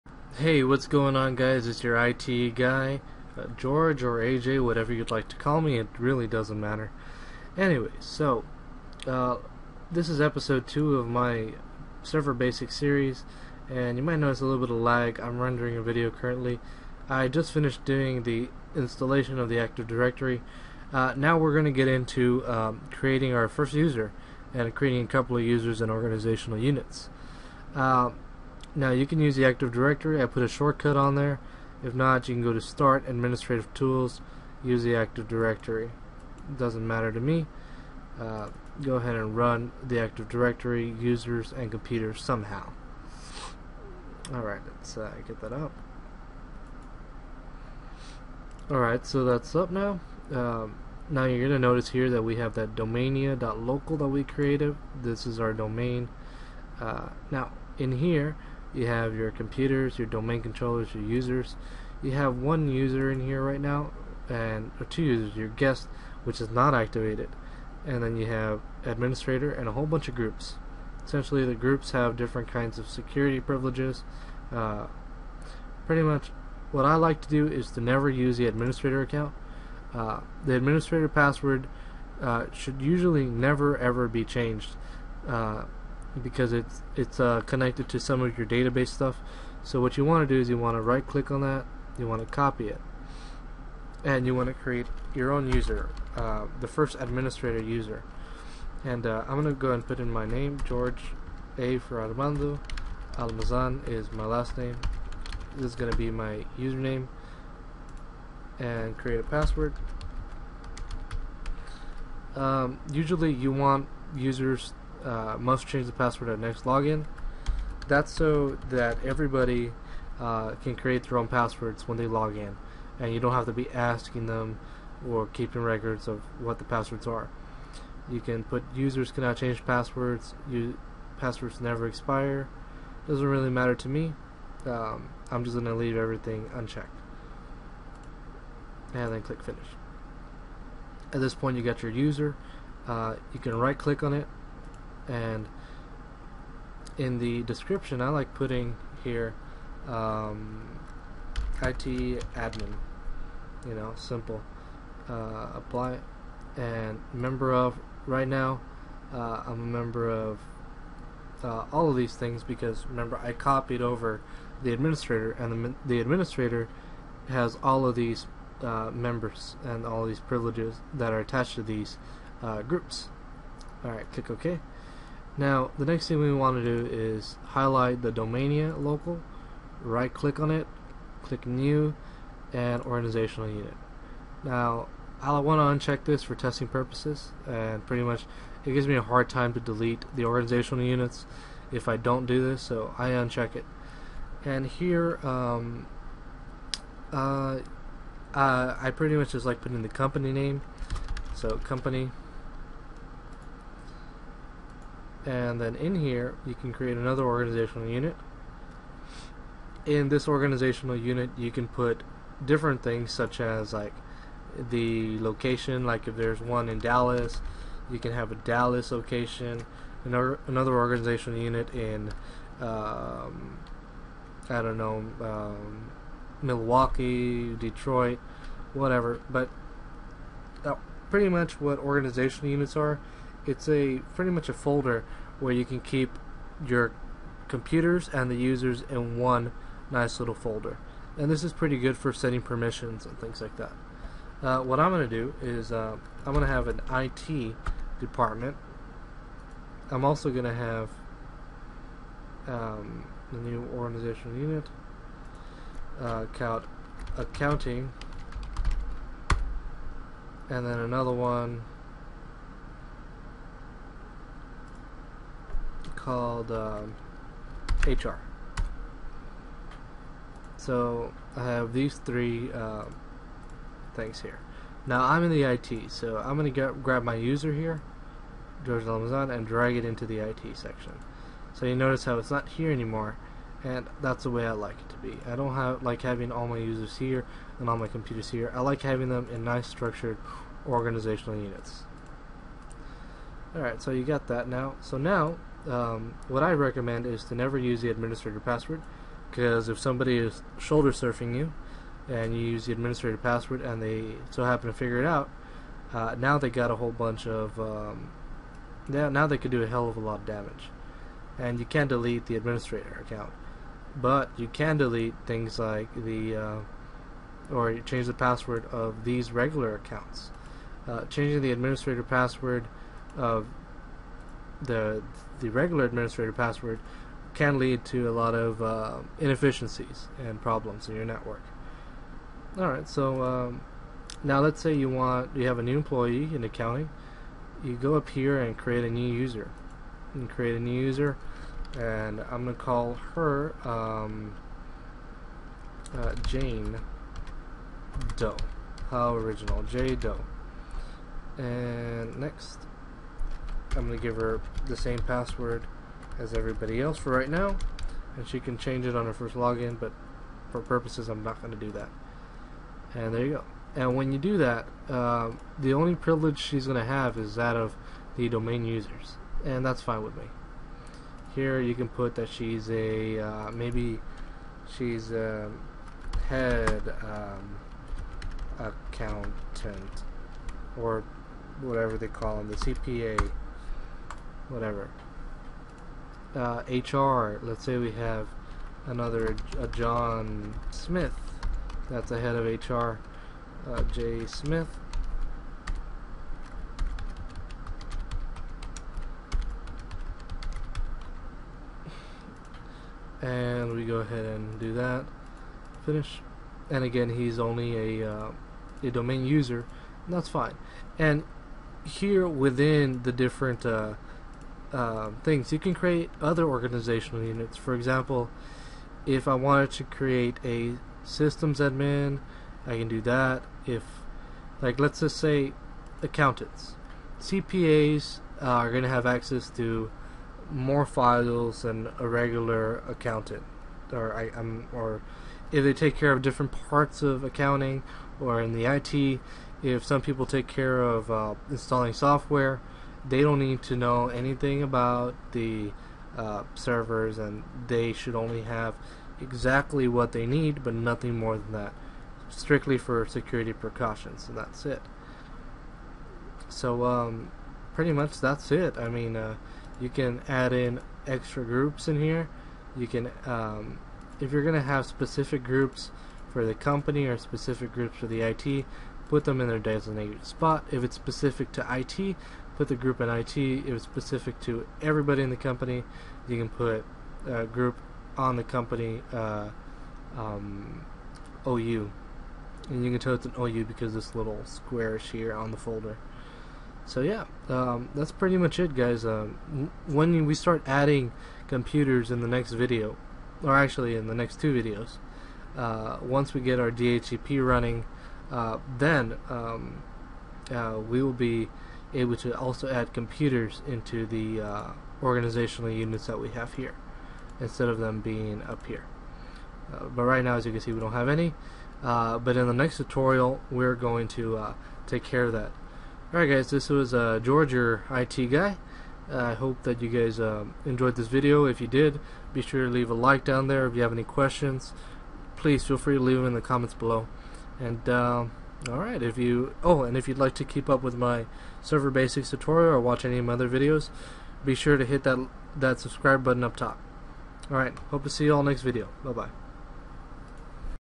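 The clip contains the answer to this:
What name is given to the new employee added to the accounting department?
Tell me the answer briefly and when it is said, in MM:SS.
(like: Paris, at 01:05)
Jane Doe, at 05:46.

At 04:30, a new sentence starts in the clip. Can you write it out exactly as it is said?
So I have these three um, things here.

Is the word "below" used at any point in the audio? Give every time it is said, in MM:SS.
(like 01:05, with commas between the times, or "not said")
08:46.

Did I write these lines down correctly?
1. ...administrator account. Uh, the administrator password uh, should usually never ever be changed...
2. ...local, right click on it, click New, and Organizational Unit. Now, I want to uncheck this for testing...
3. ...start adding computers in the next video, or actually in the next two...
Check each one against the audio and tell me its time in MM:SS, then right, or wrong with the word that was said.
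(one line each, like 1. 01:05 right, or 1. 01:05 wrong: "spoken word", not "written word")
1. 01:18 right
2. 02:58 right
3. 08:10 right.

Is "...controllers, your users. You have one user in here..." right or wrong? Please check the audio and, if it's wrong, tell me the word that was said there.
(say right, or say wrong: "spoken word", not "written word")
right.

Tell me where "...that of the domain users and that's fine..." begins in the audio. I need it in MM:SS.
06:07.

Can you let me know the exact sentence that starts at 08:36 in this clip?
Alright guys, this was uh, George, your IT guy.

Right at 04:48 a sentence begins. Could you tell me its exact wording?
I like having them in nice structured organizational units.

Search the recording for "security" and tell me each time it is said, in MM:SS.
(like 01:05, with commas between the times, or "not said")
01:12, 07:33.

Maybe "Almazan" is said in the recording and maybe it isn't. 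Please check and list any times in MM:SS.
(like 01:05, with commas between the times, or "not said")
01:43, 04:38.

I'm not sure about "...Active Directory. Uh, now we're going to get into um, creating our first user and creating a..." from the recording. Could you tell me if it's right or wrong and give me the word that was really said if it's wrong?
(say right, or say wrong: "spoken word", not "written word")
right.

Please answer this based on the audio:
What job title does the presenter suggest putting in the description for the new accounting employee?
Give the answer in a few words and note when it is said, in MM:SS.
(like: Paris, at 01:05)
CPA, at 06:22.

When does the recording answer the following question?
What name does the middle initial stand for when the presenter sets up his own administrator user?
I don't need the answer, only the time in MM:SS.
01:42.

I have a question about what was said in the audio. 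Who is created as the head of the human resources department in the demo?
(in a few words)
John Smith.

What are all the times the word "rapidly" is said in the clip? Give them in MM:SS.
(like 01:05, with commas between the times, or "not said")
not said.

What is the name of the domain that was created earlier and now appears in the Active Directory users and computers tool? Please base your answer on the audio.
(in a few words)
domania.local.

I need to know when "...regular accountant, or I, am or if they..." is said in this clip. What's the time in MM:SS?
07:12.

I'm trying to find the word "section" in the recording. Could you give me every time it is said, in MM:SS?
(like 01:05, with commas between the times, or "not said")
04:40.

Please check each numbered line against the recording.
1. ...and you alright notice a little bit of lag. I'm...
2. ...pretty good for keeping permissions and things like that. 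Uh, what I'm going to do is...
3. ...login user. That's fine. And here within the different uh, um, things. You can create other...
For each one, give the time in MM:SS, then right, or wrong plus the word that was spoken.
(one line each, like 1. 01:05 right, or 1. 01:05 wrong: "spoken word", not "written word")
1. 00:13 wrong: "might", not "alright"
2. 04:01 wrong: "setting", not "keeping"
3. 06:48 wrong: "domain", not "login".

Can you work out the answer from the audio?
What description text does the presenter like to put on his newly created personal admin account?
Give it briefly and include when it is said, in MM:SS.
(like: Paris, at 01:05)
IT admin, at 02:31.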